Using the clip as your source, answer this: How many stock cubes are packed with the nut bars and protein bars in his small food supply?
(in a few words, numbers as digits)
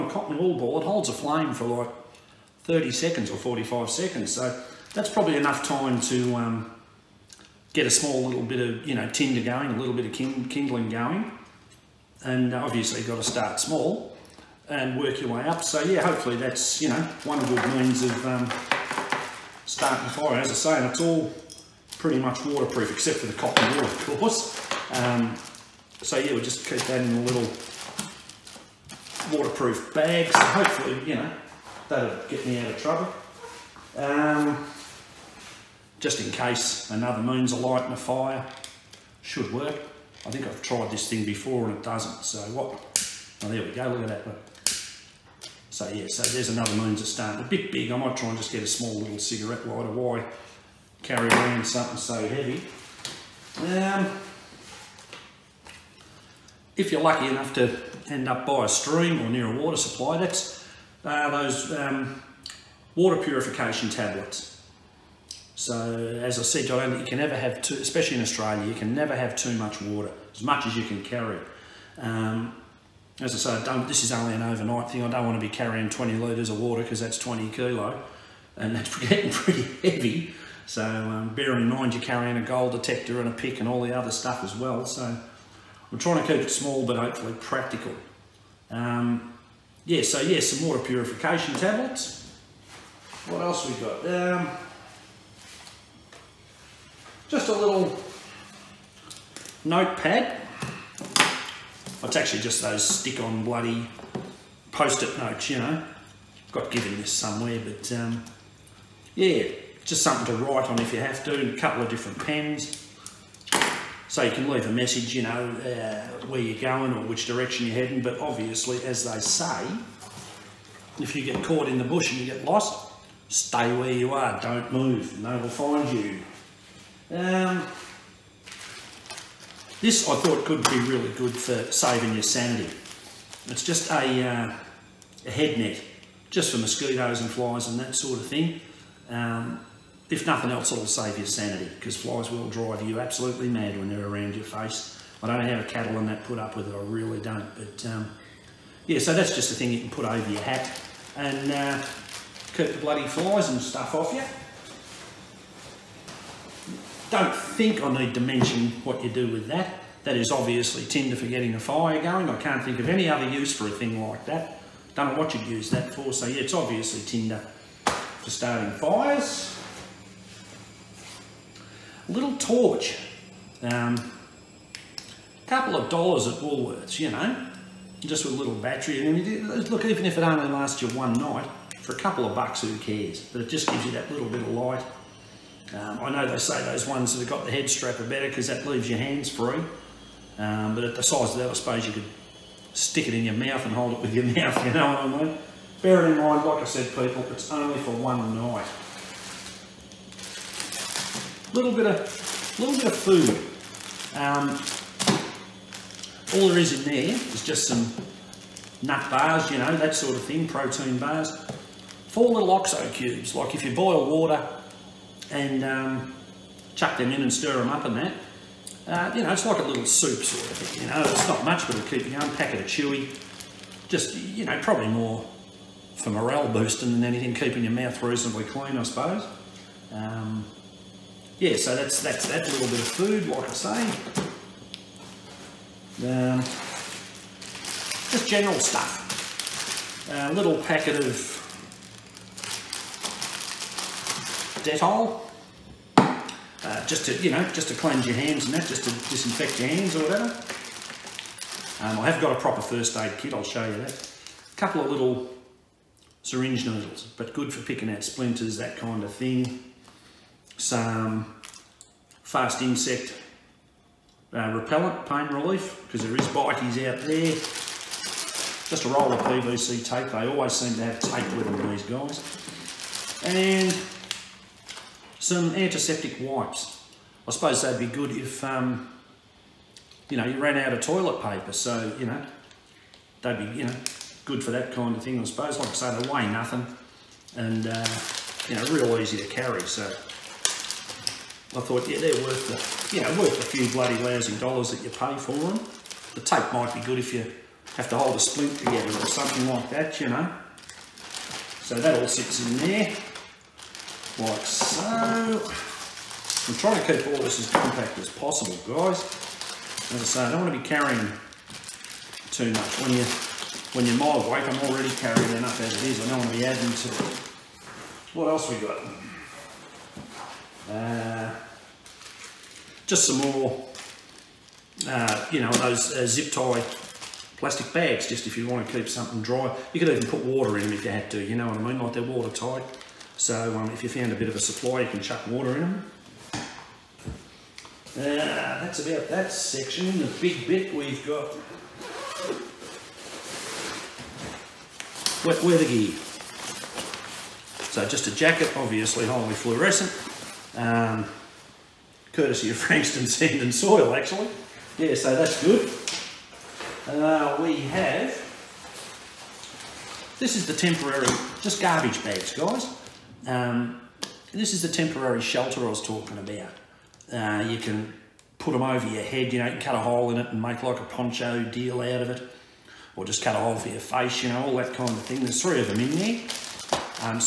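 4.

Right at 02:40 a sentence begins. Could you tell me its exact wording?
That is obviously tinder for getting a fire going.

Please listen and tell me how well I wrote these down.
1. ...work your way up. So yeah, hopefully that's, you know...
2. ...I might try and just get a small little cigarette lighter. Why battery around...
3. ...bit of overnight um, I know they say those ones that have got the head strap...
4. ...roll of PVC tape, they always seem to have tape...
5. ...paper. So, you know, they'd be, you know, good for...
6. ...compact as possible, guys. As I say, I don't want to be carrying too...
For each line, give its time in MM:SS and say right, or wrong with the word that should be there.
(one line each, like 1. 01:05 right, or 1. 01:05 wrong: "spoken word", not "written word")
1. 00:14 right
2. 00:47 wrong: "carry", not "battery"
3. 03:04 wrong: "light", not "overnight"
4. 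04:28 right
5. 04:41 right
6. 05:07 right.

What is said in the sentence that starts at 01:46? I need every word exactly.
Got given this somewhere, but um, yeah, just something to write on if you have to.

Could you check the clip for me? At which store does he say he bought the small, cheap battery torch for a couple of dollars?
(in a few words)
Woolworths.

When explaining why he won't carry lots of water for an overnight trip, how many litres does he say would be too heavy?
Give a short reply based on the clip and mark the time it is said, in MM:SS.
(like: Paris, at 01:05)
20 litres, at 01:15.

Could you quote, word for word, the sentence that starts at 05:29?
You could even put water in them if you had to, you know what I mean?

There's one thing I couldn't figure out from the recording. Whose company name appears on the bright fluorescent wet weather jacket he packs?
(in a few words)
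Frankston Sand and Soil.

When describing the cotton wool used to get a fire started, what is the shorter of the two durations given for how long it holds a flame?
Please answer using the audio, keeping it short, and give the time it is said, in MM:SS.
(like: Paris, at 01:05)
30 seconds, at 00:02.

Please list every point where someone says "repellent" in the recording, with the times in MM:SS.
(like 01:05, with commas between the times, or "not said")
04:24.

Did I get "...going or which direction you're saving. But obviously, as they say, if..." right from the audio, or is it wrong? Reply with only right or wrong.
wrong.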